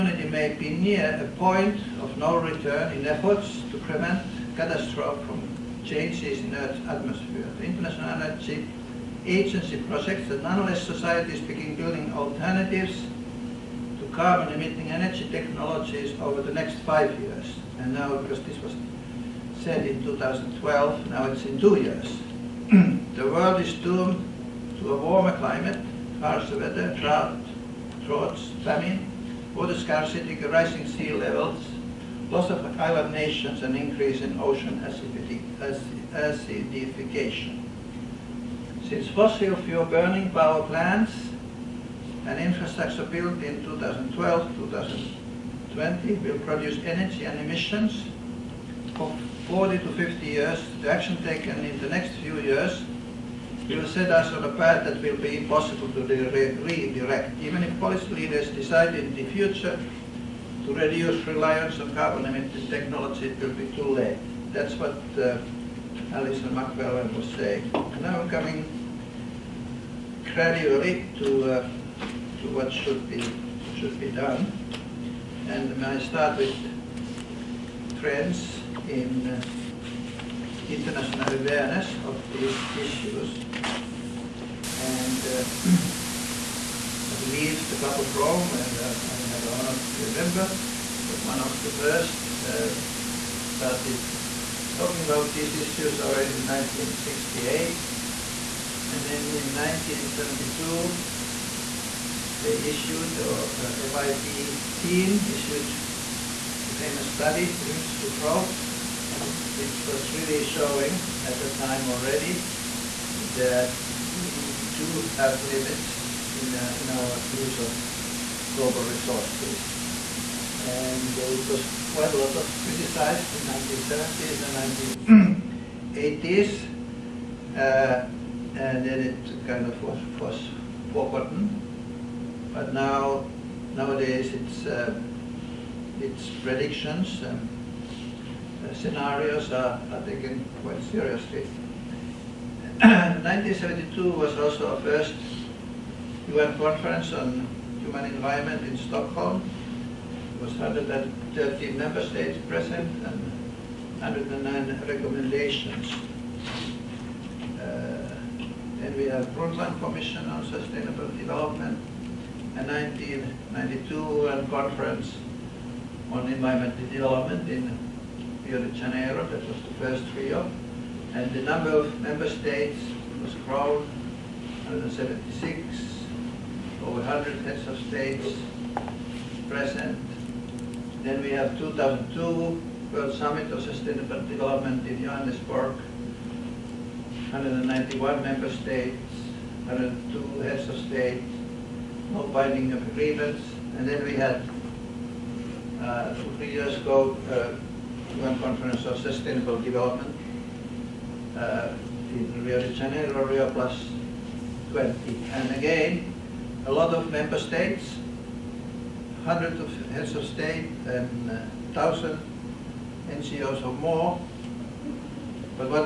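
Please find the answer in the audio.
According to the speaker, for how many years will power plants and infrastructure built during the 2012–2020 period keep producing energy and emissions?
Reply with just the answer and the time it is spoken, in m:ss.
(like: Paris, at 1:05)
40 to 50 years, at 0:49.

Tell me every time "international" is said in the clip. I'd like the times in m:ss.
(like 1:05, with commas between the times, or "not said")
0:07, 1:20.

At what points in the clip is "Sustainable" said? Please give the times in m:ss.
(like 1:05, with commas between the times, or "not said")
2:40, 3:03, 3:19.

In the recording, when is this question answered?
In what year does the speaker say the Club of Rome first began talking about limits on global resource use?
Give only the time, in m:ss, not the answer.
1:36.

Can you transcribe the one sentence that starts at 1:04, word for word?
That's what uh, Allison Macfarlane was saying.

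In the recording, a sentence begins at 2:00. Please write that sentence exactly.
And it was quite a lot of criticized in 1970s and 1980s.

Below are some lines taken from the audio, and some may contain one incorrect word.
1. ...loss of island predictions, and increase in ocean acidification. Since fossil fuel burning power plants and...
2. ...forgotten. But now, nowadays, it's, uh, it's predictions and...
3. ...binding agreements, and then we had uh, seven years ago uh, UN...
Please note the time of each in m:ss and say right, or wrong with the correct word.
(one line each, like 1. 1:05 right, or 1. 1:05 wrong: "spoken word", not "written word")
1. 0:32 wrong: "nations", not "predictions"
2. 2:10 right
3. 3:12 wrong: "three", not "seven".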